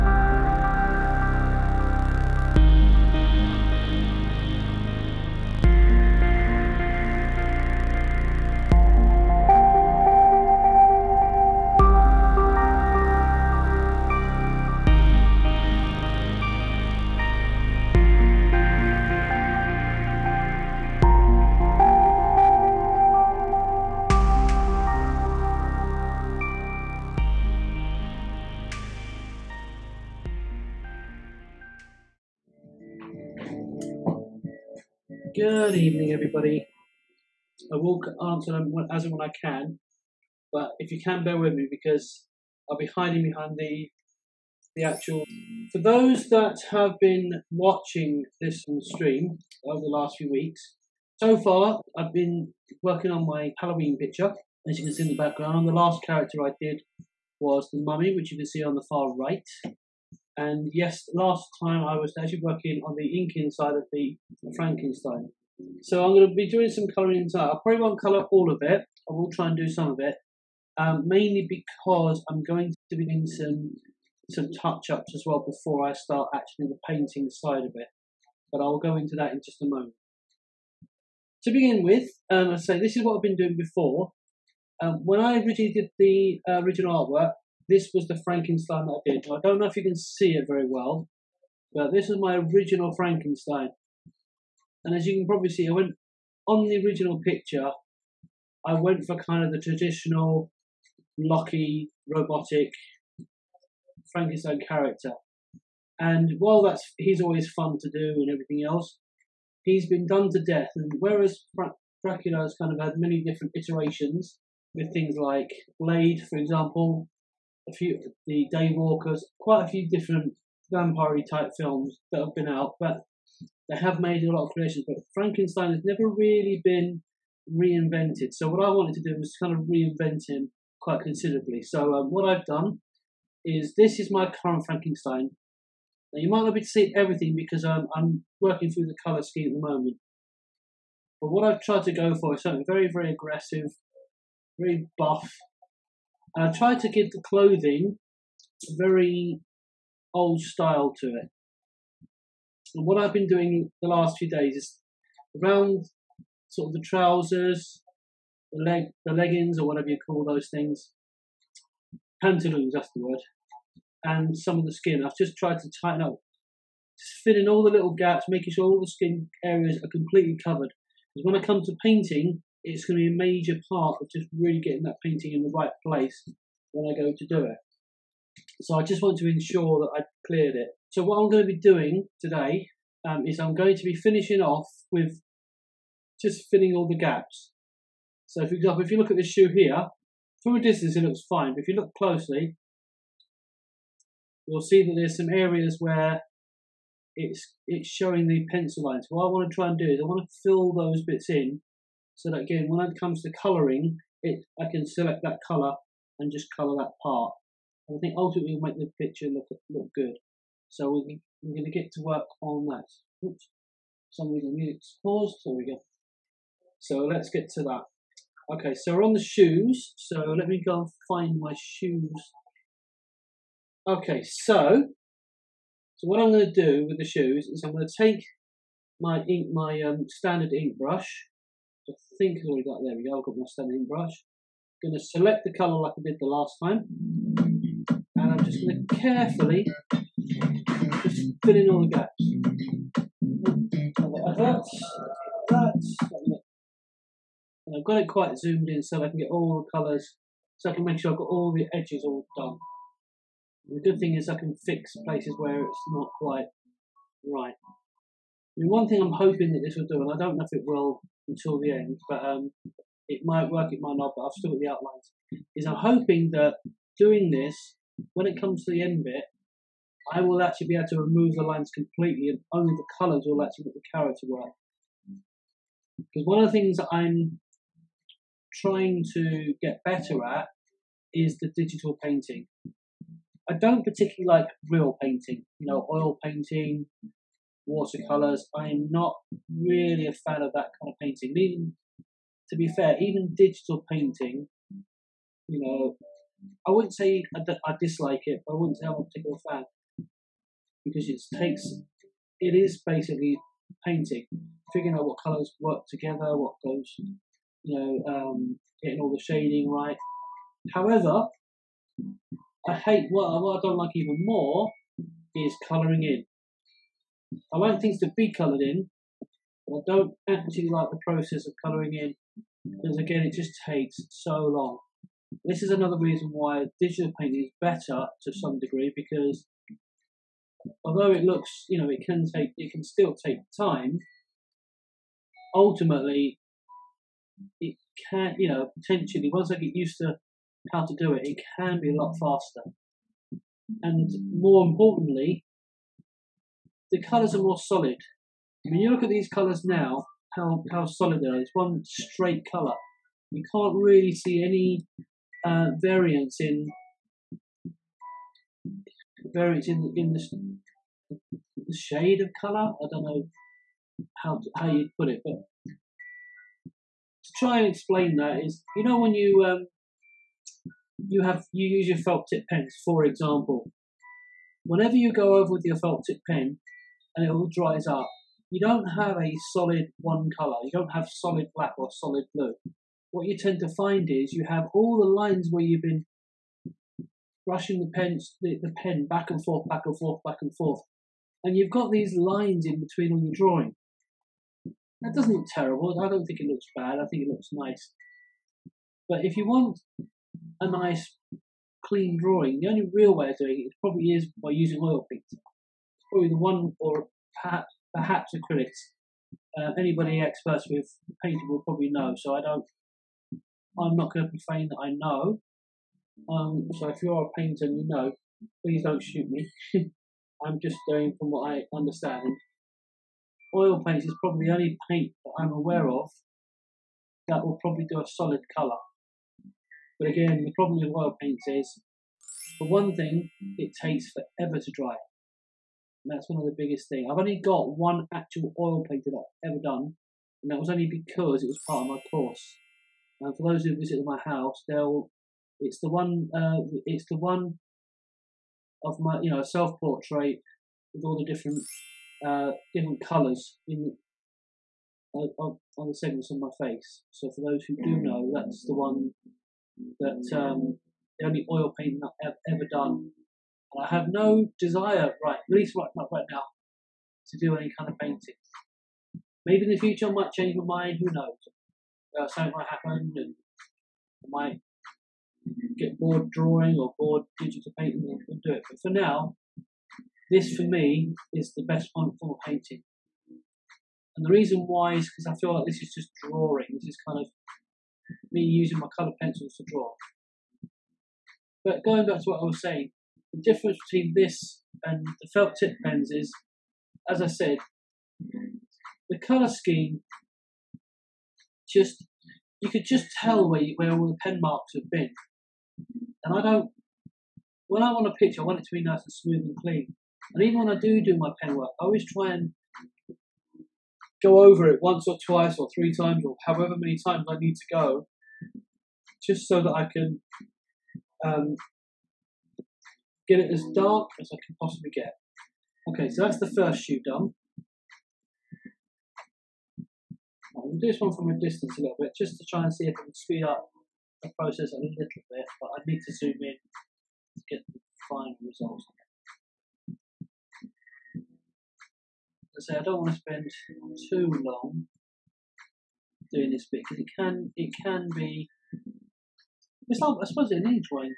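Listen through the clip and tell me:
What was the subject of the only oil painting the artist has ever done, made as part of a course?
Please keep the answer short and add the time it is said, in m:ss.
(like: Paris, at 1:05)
Self portrait, at 7:29.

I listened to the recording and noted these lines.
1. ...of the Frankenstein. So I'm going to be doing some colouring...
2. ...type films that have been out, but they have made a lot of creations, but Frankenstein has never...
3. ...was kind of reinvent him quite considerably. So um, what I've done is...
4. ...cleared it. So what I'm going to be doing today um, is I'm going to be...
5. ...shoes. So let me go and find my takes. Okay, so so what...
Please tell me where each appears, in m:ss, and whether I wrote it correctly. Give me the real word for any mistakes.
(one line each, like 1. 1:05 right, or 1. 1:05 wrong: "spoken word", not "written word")
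1. 1:03 right
2. 2:01 right
3. 2:09 right
4. 3:00 right
5. 3:39 wrong: "shoes", not "takes".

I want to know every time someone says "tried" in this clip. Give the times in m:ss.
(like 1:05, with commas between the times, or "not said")
2:21, 2:26, 2:45.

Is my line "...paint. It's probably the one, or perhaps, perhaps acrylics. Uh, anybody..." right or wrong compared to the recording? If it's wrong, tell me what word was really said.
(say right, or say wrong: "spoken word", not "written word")
right.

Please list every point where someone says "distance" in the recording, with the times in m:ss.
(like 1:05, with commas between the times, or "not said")
3:10, 8:51.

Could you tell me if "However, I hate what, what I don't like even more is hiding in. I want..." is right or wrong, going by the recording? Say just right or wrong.
wrong.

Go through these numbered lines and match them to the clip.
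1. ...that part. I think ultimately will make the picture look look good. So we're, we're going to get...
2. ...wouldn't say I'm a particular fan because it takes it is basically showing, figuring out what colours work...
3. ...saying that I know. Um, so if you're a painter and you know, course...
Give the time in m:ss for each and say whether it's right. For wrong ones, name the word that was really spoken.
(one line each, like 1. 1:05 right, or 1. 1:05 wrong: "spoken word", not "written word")
1. 3:26 right
2. 4:58 wrong: "painting", not "showing"
3. 6:54 wrong: "please", not "course".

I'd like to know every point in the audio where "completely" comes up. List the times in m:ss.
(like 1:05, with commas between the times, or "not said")
2:49, 4:31.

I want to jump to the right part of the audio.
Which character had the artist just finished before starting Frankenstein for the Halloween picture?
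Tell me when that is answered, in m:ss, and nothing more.
0:57.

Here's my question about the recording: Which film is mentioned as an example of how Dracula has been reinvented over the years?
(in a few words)
Blade.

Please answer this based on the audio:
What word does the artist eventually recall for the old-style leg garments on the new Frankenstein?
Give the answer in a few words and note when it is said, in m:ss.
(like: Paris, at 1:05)
Pantaloons, at 2:42.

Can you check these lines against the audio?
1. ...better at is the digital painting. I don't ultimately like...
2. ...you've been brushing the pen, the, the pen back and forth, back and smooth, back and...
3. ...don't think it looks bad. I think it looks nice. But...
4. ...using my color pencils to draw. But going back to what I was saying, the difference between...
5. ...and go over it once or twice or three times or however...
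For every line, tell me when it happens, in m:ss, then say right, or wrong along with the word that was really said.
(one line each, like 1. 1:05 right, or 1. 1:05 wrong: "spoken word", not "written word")
1. 4:39 wrong: "particularly", not "ultimately"
2. 6:25 wrong: "forth", not "smooth"
3. 6:36 right
4. 8:08 right
5. 8:32 right.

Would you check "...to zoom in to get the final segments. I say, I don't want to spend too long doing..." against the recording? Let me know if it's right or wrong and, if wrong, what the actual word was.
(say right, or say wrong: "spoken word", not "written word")
wrong: "results", not "segments".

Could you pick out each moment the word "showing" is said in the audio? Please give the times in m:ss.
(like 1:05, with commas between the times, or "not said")
3:17.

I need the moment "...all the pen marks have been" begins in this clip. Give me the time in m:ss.
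8:23.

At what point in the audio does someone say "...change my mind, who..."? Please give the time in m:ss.
7:50.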